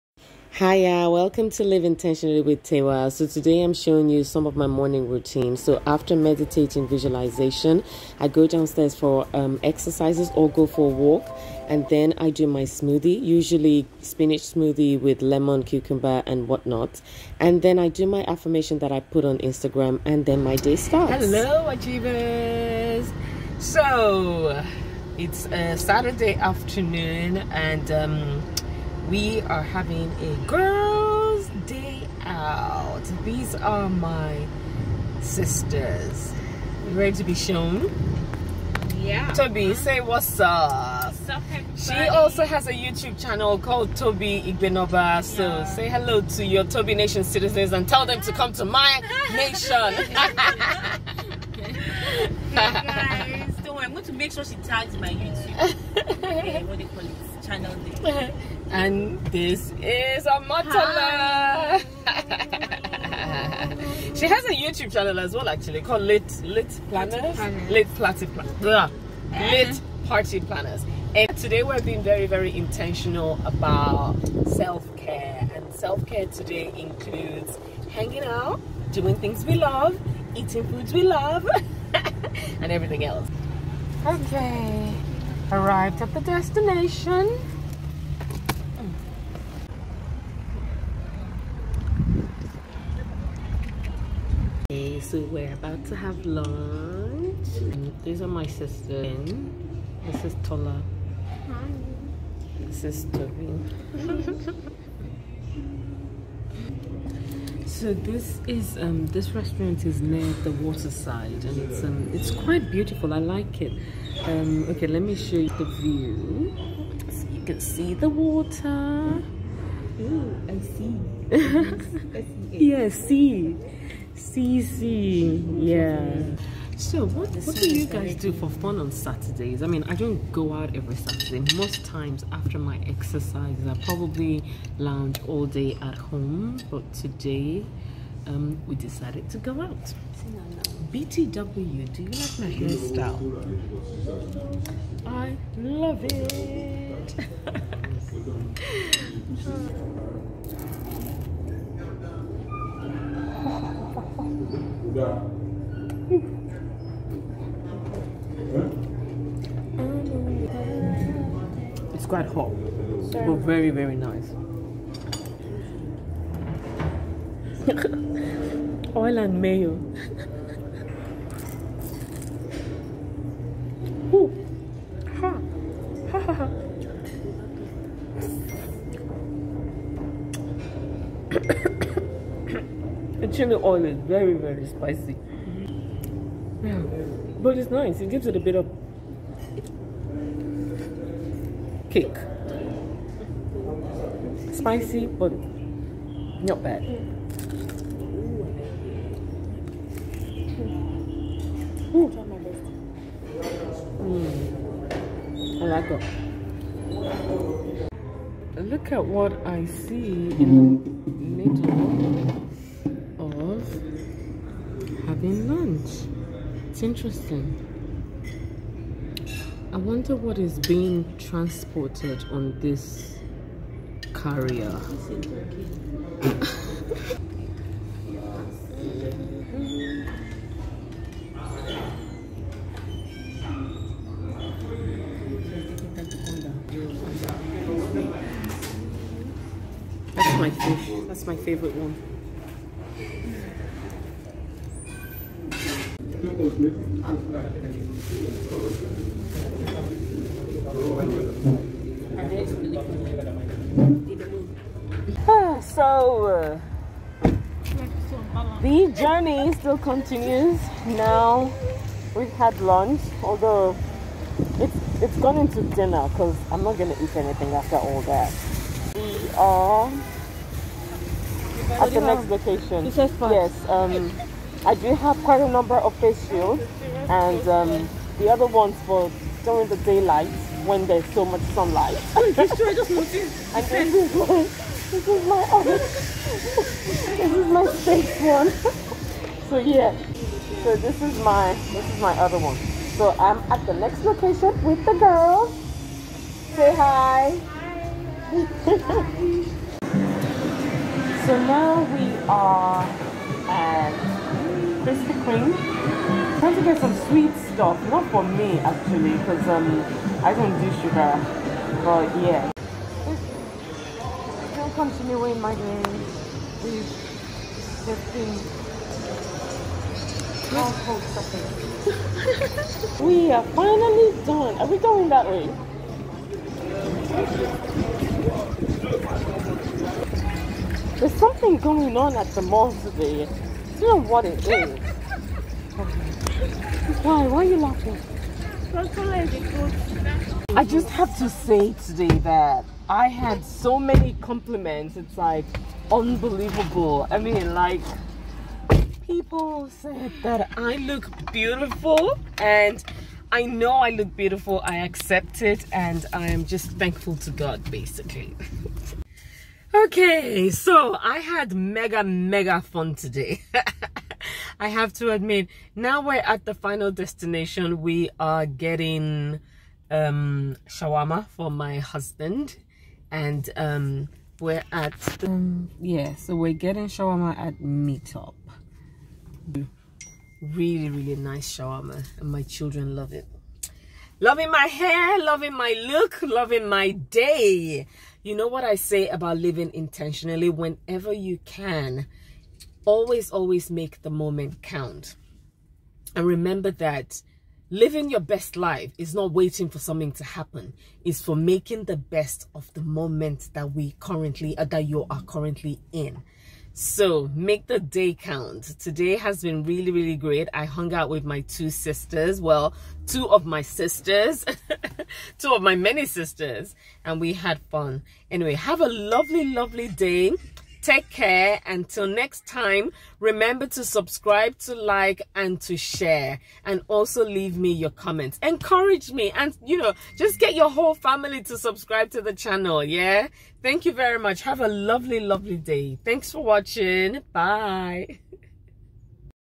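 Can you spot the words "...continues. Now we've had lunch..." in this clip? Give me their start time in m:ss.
4:19.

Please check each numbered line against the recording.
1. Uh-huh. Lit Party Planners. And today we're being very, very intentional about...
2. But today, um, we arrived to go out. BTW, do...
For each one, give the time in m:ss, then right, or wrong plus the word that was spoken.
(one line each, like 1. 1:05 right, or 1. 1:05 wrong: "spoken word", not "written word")
1. 1:08 right
2. 2:16 wrong: "decided", not "arrived".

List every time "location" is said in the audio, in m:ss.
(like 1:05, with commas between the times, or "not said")
4:32, 4:54.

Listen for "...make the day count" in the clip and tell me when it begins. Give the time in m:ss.
6:47.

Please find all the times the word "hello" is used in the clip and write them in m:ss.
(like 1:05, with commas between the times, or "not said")
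0:21, 0:45.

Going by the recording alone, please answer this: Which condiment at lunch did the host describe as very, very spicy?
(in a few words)
Chili oil.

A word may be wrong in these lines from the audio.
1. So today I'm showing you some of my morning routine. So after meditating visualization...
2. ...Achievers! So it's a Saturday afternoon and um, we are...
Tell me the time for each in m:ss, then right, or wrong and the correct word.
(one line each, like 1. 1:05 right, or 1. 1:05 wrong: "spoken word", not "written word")
1. 0:03 right
2. 0:21 right.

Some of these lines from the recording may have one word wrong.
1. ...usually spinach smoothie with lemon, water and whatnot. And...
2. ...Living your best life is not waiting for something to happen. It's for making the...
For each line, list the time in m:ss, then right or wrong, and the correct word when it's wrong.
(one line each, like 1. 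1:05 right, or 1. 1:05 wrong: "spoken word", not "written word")
1. 0:13 wrong: "cucumber", not "water"
2. 6:37 right.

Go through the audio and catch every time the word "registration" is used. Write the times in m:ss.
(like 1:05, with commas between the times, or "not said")
not said.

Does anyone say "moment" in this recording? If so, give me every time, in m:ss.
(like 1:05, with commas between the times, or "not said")
6:34, 6:42.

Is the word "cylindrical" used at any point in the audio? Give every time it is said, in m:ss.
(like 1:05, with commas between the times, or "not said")
not said.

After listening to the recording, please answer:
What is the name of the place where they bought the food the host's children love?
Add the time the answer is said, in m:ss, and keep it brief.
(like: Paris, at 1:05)
Meetup, at 6:17.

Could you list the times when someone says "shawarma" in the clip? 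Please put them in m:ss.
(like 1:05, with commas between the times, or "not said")
6:10, 6:16, 6:21.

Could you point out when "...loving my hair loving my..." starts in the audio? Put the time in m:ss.
6:24.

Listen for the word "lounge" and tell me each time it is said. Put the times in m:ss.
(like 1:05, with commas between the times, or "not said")
2:14.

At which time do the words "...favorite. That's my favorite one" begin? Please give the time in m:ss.
4:00.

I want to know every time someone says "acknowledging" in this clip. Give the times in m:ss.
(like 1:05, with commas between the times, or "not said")
not said.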